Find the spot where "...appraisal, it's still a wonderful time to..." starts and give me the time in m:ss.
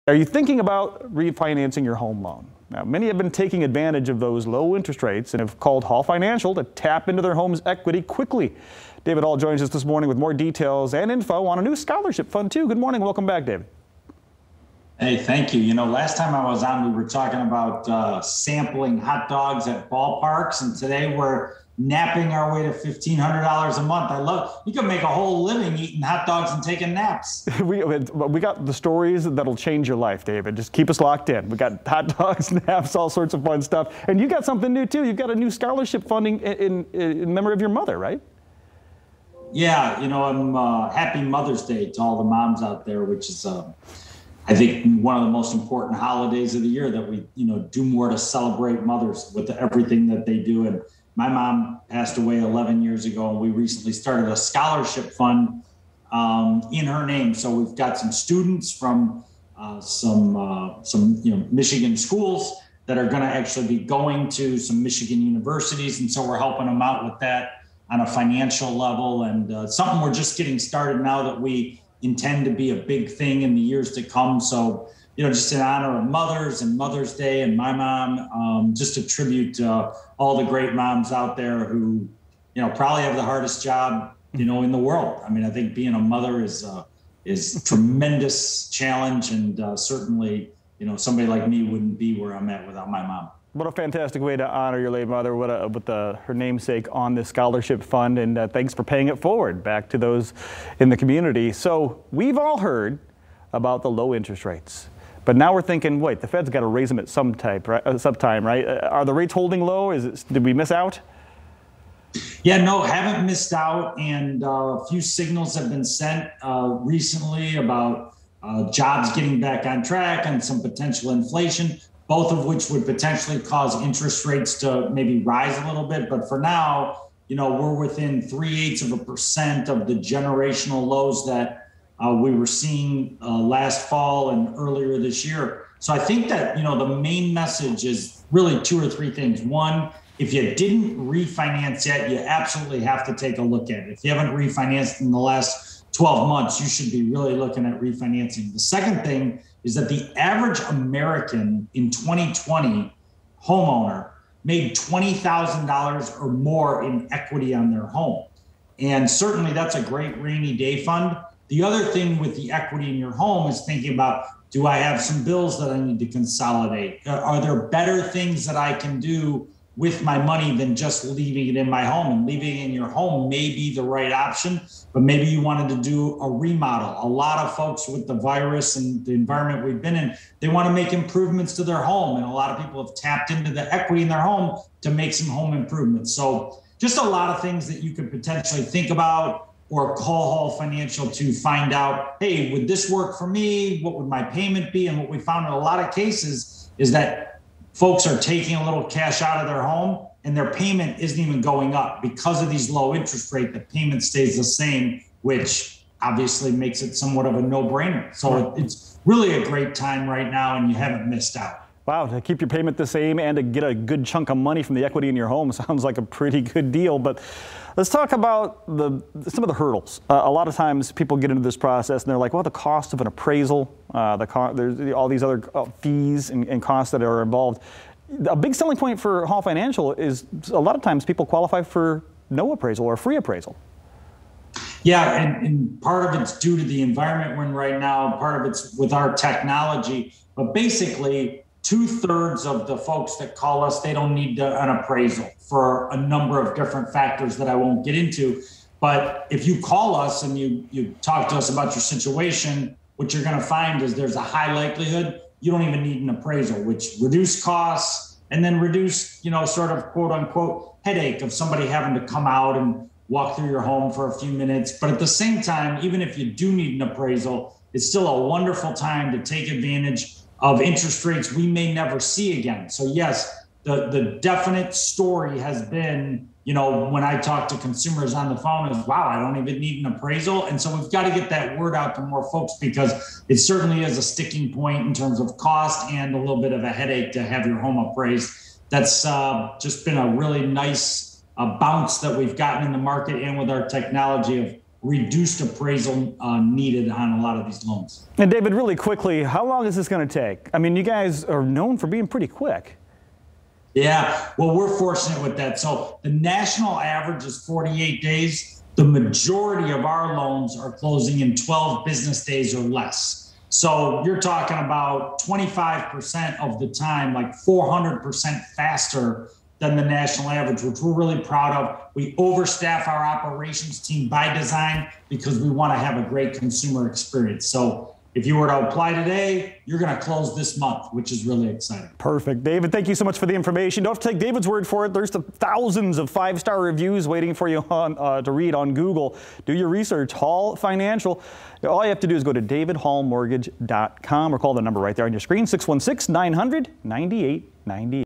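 4:26.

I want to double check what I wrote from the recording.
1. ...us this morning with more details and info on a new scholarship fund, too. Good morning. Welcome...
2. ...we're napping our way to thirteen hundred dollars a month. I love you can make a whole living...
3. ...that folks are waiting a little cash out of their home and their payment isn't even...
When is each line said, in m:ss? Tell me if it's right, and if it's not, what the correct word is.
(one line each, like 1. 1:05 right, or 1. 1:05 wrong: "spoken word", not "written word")
1. 0:09 right
2. 0:21 wrong: "fifteen", not "thirteen"
3. 3:16 wrong: "taking", not "waiting".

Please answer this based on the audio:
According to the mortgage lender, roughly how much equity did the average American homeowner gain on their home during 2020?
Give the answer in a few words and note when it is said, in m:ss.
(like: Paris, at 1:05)
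$20,000, at 2:34.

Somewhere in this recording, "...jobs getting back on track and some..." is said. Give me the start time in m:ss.
1:58.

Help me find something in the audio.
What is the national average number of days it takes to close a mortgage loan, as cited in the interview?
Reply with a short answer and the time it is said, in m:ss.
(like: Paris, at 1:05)
48 days, at 5:07.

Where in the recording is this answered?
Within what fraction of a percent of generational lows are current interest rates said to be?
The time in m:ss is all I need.
2:08.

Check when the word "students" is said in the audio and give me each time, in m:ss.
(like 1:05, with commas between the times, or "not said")
0:58.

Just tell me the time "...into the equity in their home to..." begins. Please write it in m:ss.
3:03.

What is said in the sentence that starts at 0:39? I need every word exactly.
Yeah, you know, I'm uh, happy Mother's Day to all the moms out there, which is.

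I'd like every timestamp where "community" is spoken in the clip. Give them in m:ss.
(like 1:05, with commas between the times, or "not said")
1:40.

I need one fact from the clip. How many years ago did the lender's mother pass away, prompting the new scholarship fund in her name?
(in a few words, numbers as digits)
11.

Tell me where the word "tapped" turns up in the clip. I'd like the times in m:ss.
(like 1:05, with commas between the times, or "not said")
3:02.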